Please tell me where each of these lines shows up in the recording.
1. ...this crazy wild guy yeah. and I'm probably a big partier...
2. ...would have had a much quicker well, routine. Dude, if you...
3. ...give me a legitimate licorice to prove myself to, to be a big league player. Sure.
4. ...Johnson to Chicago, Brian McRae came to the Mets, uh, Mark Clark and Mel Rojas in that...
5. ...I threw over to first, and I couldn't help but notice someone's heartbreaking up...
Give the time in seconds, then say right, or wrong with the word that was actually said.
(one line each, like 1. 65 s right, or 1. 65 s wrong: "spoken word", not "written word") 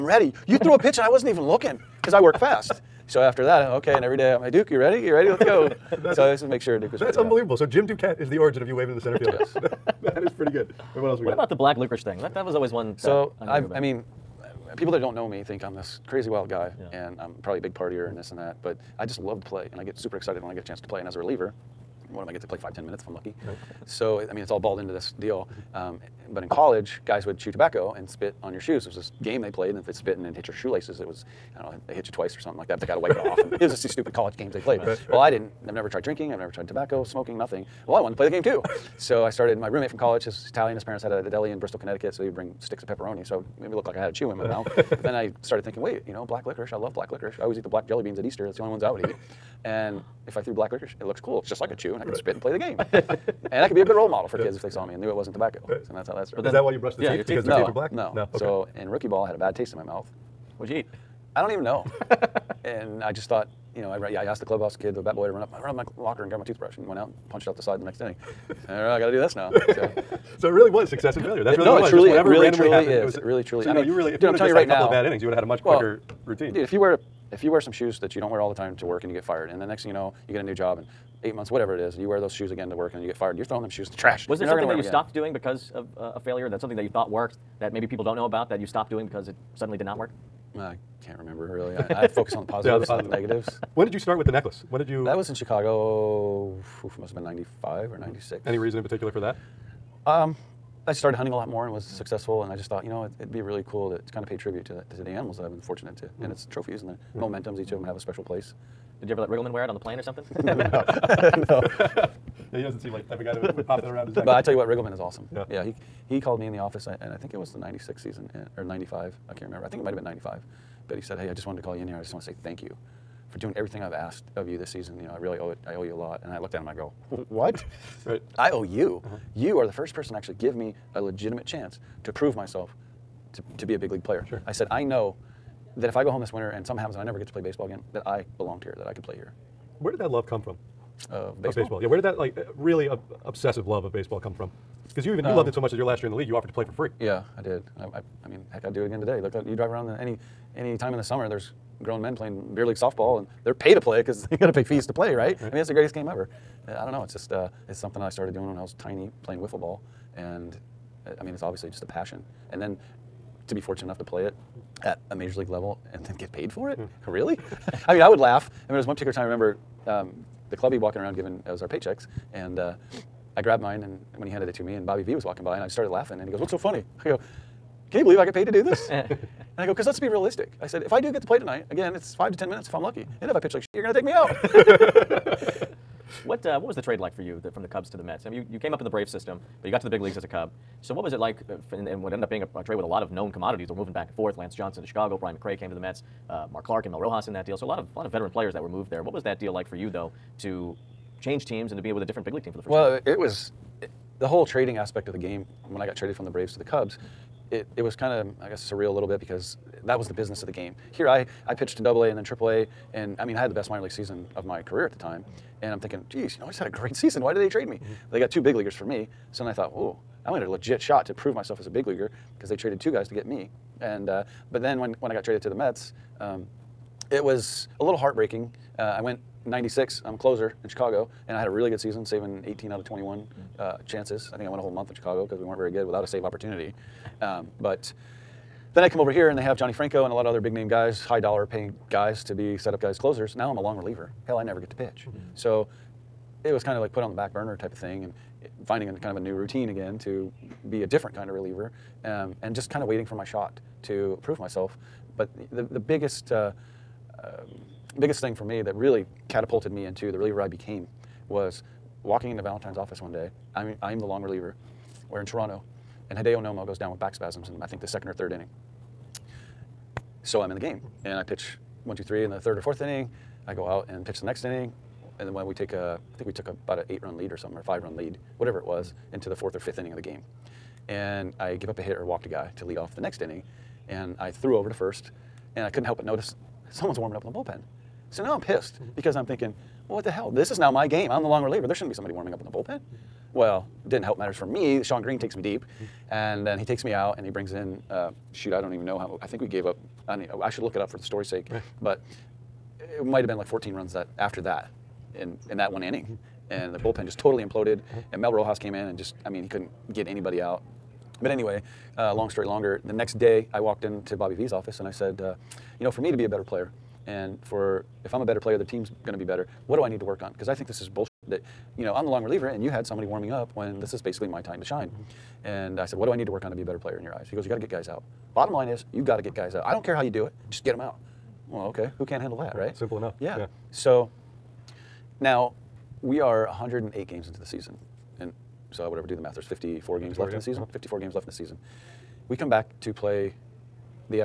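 1. 15 s right
2. 75 s right
3. 130 s wrong: "chance", not "licorice"
4. 194 s right
5. 284 s wrong: "warming", not "heartbreaking".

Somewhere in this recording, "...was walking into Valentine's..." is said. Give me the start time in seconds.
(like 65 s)
261 s.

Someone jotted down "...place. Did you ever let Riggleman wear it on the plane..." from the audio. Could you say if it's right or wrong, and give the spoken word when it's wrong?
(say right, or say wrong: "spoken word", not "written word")
right.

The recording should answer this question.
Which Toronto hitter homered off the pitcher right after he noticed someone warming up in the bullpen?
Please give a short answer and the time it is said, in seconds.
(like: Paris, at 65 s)
Shawn Green, at 294 s.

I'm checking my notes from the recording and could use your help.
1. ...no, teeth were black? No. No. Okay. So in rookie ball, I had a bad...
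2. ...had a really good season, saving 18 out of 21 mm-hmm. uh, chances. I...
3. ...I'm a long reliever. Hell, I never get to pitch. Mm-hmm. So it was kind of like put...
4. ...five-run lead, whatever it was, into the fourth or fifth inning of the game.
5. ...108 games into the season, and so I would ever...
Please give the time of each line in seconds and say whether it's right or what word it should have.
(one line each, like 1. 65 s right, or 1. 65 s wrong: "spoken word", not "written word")
1. 57 s right
2. 231 s right
3. 243 s right
4. 277 s right
5. 336 s right.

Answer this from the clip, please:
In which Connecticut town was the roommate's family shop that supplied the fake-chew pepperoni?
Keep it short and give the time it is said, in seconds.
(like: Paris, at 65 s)
Bristol, at 41 s.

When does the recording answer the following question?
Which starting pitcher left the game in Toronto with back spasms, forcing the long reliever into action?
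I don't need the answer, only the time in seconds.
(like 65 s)
266 s.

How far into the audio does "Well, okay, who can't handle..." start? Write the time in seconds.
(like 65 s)
331 s.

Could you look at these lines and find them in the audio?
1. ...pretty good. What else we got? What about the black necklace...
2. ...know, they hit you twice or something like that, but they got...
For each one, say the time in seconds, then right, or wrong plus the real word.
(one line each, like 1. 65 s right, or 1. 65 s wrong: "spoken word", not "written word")
1. 10 s wrong: "licorice", not "necklace"
2. 31 s right.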